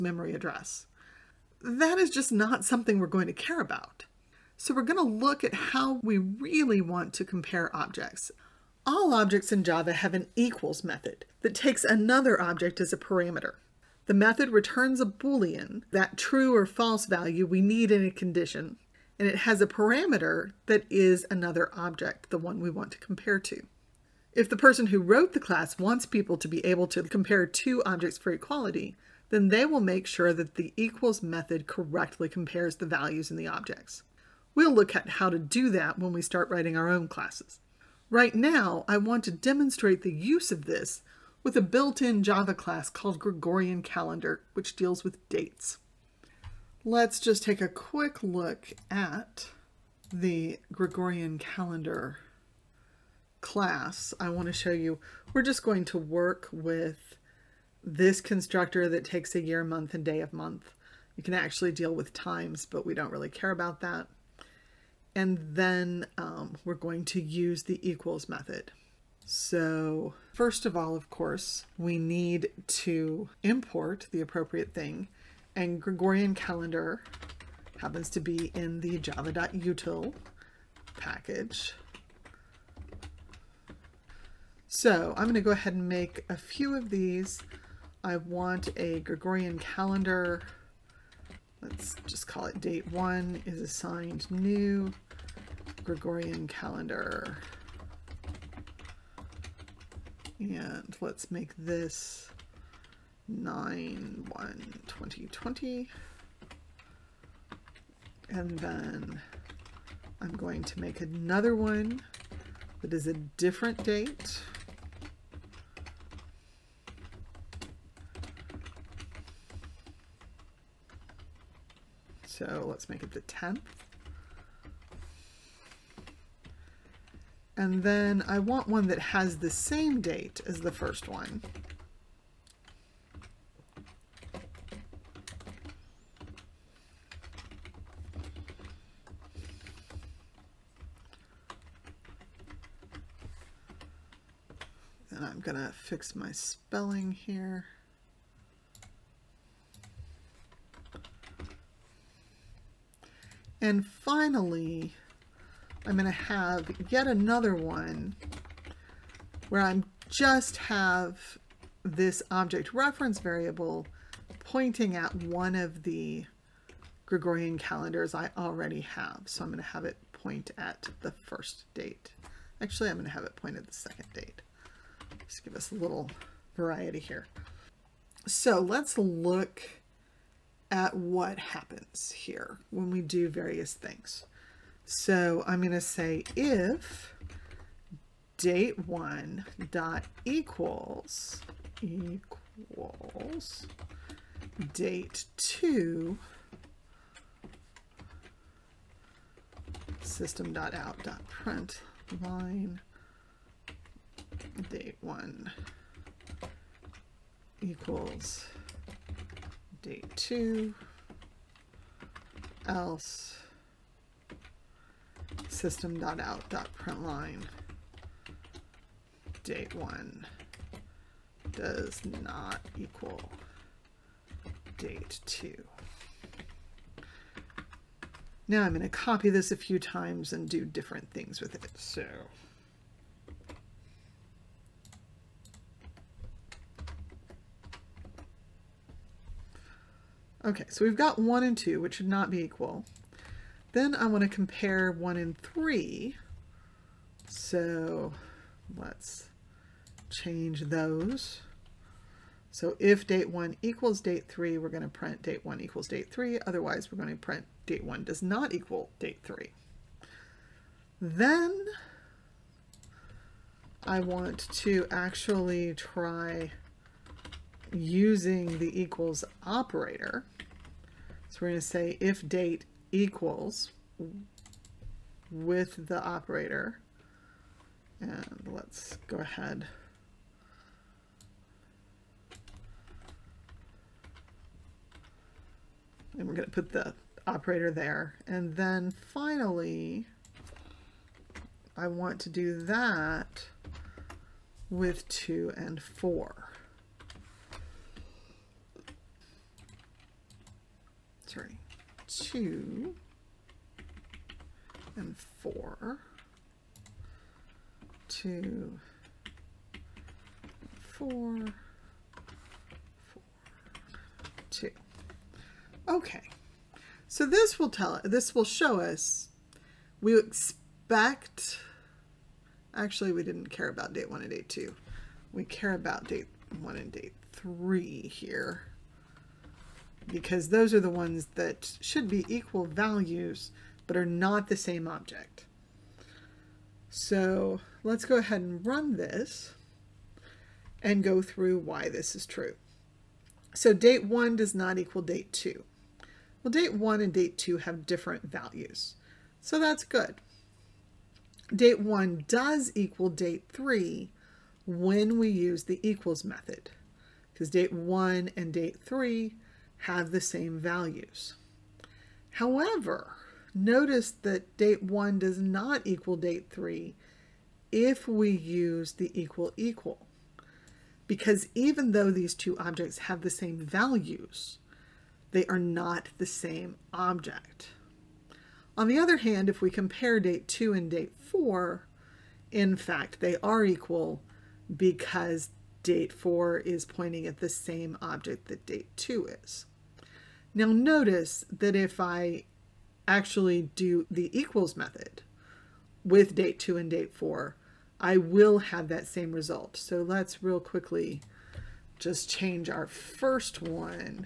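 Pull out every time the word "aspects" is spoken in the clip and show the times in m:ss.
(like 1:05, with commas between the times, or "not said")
not said.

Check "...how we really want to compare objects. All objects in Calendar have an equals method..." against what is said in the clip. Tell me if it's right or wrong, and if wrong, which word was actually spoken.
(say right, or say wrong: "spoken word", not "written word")
wrong: "Java", not "Calendar".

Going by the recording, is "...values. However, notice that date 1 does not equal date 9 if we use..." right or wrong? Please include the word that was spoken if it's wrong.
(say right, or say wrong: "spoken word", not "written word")
wrong: "3", not "9".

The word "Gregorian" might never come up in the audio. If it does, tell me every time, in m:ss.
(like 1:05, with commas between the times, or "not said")
0:43, 0:50, 1:15, 1:28, 1:35, 2:47.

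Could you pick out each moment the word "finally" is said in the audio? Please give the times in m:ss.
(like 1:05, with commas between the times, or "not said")
2:33, 4:48.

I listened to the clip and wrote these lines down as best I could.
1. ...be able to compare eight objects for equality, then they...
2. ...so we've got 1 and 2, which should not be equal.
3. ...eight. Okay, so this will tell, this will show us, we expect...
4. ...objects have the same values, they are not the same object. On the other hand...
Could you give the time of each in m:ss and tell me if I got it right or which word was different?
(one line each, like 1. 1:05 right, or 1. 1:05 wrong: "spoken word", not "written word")
1. 0:26 wrong: "two", not "eight"
2. 4:00 right
3. 5:14 wrong: "two", not "eight"
4. 6:12 right.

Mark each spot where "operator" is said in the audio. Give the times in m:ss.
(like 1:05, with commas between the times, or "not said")
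4:29, 4:36, 4:47.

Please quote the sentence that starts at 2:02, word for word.
So let's make it the 10th.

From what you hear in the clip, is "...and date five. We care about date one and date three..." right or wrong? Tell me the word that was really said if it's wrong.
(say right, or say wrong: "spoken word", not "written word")
wrong: "two", not "five".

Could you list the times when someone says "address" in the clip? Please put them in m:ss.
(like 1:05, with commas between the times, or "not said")
0:00.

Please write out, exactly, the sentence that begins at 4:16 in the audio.
Otherwise, we're going to print date 1 does not equal date 3.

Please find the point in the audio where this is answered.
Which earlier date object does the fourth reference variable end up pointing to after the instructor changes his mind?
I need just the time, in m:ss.
2:53.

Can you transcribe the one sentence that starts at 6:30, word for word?
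Now notice that if I actually do the equals method with date two and date four, I will have that same result.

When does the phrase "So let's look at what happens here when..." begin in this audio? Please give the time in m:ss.
2:58.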